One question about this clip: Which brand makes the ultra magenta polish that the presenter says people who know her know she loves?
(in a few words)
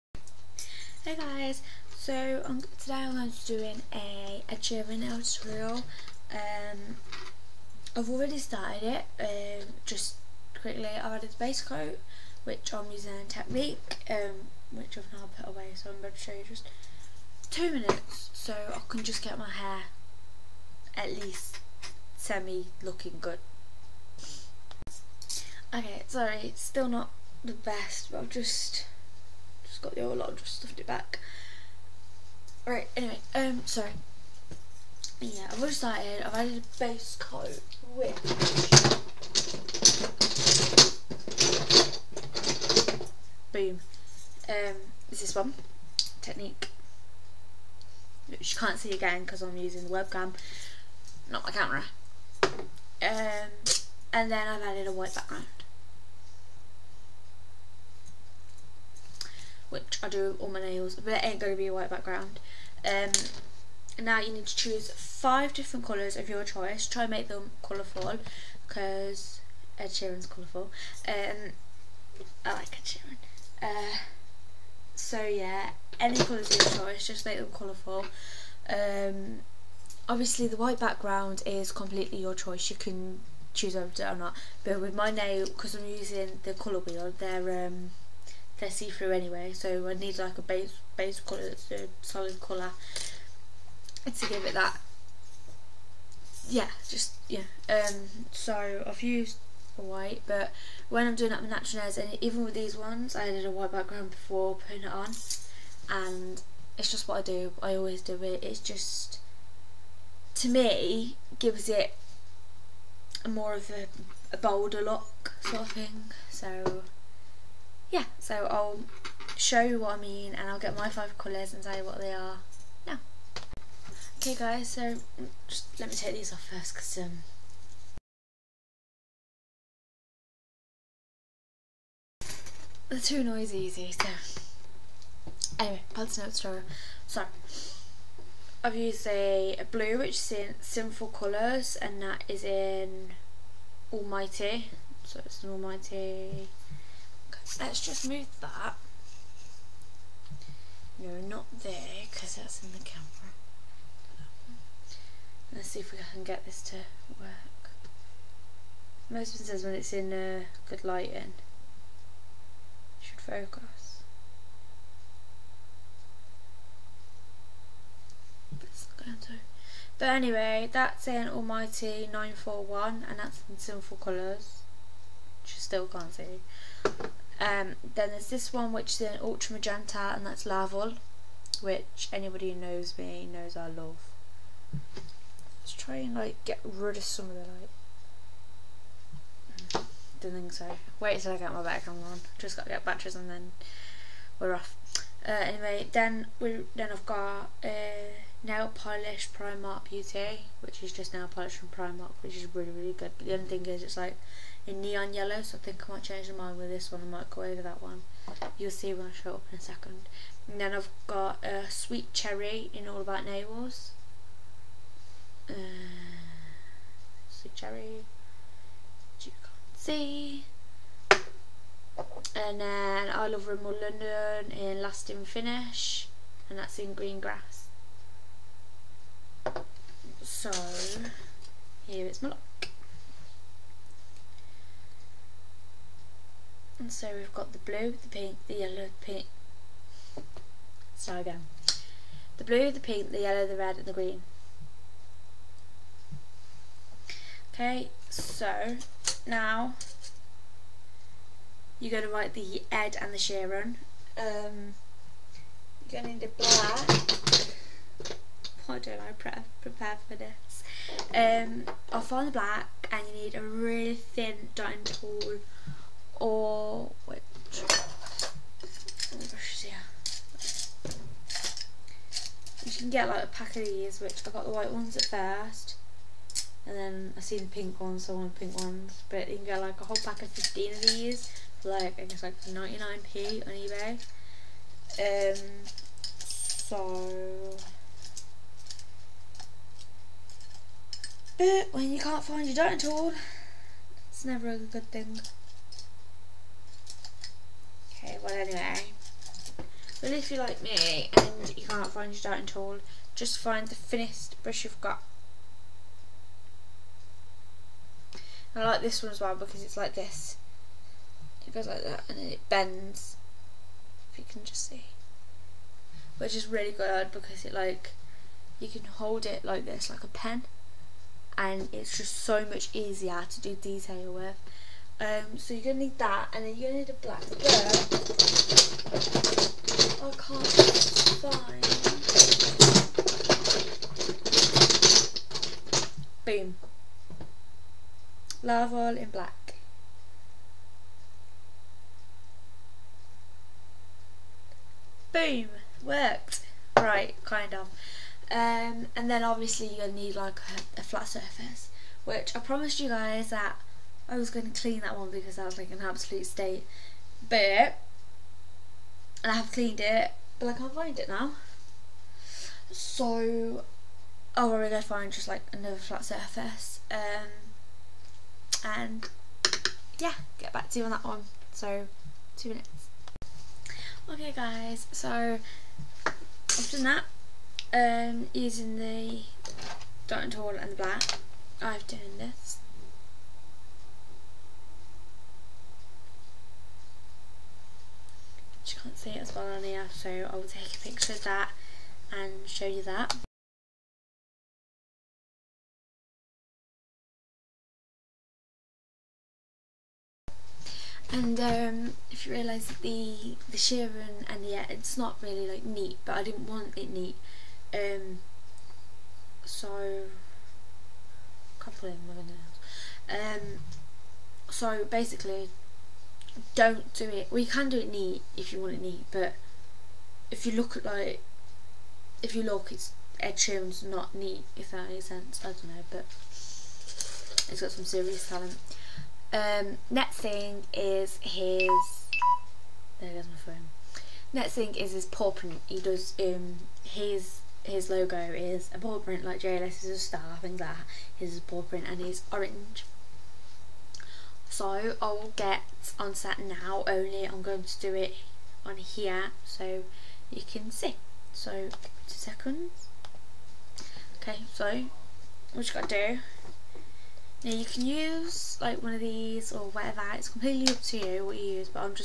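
Laval.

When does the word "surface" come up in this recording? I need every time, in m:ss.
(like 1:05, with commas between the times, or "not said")
5:51, 6:06.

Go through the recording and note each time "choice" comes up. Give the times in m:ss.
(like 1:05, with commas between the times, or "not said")
1:06, 1:16, 1:22.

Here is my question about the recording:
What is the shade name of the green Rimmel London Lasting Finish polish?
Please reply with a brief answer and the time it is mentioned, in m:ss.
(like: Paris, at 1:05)
Green Grass, at 3:46.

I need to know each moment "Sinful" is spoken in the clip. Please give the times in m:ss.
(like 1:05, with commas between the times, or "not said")
2:20, 2:53.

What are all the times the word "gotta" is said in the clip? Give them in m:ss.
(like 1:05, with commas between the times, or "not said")
3:12, 7:35.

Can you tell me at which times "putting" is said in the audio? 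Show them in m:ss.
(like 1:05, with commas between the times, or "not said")
1:44.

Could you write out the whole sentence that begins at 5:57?
But, and I have cleaned it, but I can't find it now.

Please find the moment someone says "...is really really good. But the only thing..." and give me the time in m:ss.
3:22.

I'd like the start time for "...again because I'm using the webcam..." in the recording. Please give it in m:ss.
0:48.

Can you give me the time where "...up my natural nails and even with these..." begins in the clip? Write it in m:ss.
1:41.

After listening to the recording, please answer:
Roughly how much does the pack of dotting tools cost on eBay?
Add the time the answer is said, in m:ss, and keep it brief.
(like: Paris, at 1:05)
99p, at 4:42.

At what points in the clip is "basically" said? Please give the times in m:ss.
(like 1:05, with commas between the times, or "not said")
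6:54.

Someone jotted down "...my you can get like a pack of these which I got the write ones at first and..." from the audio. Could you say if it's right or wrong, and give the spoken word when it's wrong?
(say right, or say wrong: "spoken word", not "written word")
wrong: "white", not "write".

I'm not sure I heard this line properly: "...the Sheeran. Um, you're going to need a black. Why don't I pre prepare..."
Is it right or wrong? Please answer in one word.
right.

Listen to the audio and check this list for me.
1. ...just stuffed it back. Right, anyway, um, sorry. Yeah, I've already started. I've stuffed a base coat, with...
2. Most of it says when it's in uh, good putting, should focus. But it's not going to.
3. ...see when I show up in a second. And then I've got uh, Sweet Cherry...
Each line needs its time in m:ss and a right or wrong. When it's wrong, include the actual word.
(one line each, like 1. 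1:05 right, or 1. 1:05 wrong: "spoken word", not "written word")
1. 0:30 wrong: "added", not "stuffed"
2. 2:39 wrong: "lighting", not "putting"
3. 3:28 right.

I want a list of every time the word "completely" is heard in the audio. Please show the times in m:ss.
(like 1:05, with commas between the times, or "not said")
1:21, 7:40.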